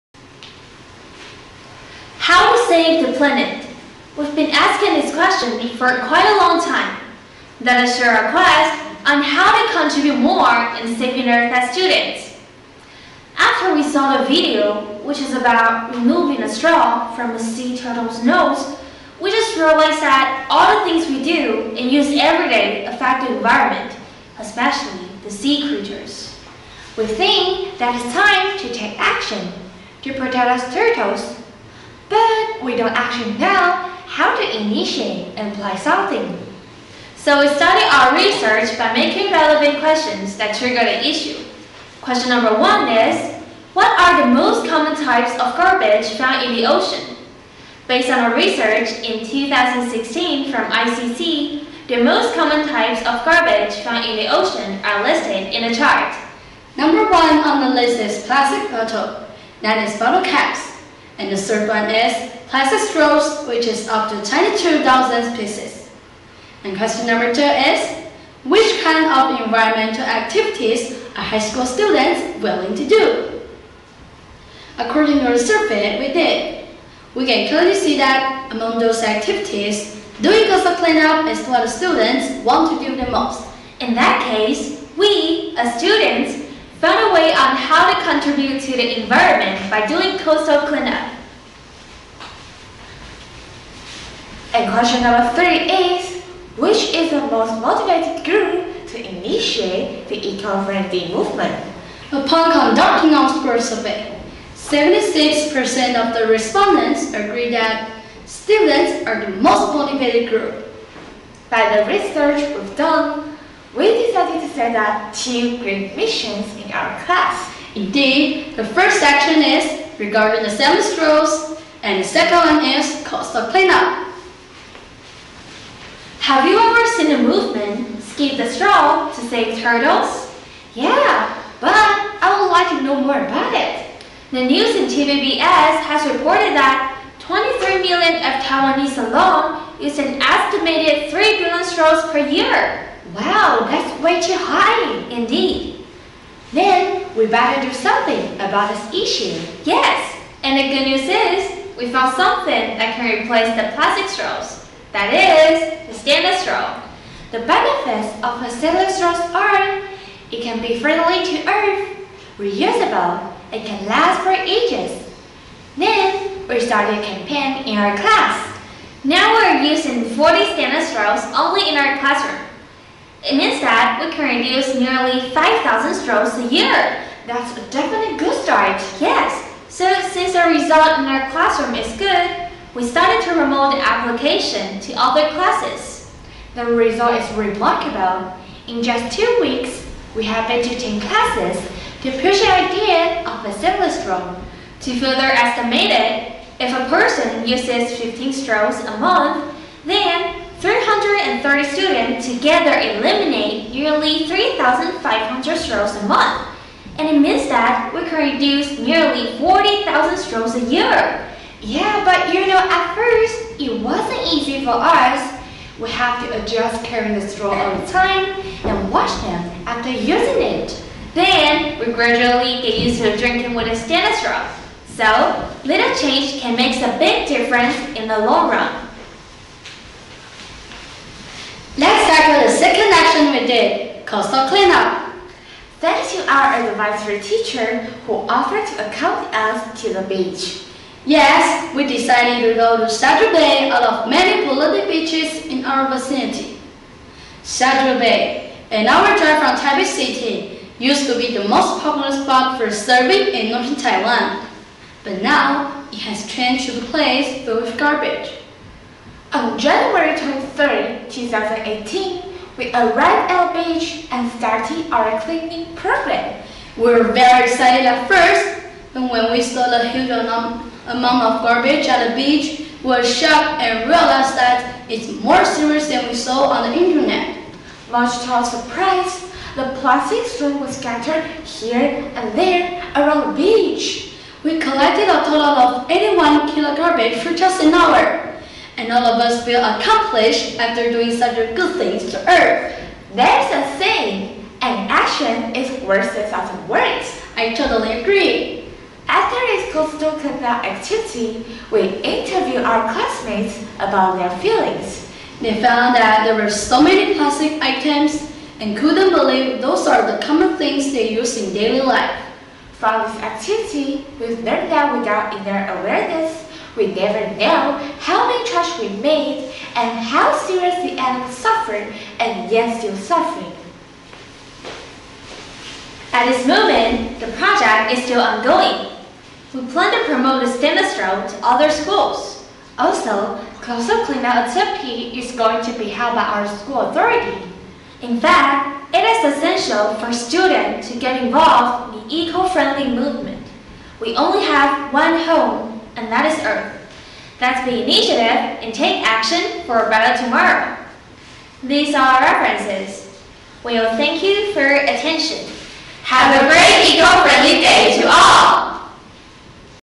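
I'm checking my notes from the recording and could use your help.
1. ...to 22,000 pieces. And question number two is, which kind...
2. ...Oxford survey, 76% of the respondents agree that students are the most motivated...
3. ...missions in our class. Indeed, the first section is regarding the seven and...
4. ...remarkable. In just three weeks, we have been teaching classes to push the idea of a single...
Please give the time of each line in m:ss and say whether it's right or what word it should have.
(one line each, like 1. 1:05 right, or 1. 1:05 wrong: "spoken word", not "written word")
1. 1:04 right
2. 1:43 right
3. 1:55 right
4. 3:07 wrong: "two", not "three".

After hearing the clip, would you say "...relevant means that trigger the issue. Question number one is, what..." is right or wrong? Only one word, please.
wrong.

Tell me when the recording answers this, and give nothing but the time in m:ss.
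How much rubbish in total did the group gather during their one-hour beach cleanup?
4:45.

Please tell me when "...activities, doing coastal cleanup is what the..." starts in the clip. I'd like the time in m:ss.
1:19.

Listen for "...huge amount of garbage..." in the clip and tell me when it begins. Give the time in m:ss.
4:29.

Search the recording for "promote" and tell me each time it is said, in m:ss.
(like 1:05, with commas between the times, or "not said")
3:03, 5:30.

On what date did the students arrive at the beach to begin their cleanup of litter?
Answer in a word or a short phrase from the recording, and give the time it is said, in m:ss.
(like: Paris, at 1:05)
January 23, 2018, at 4:19.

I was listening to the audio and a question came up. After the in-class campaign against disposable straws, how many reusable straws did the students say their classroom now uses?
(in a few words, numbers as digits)
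40.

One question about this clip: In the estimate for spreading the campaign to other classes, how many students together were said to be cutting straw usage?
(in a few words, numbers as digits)
330.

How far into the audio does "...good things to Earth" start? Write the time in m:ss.
4:51.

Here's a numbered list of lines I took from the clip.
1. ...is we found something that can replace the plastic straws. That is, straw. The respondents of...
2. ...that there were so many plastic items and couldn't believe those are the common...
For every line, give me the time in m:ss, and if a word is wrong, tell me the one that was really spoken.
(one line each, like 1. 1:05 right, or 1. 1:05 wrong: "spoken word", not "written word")
1. 2:31 wrong: "benefits", not "respondents"
2. 5:05 right.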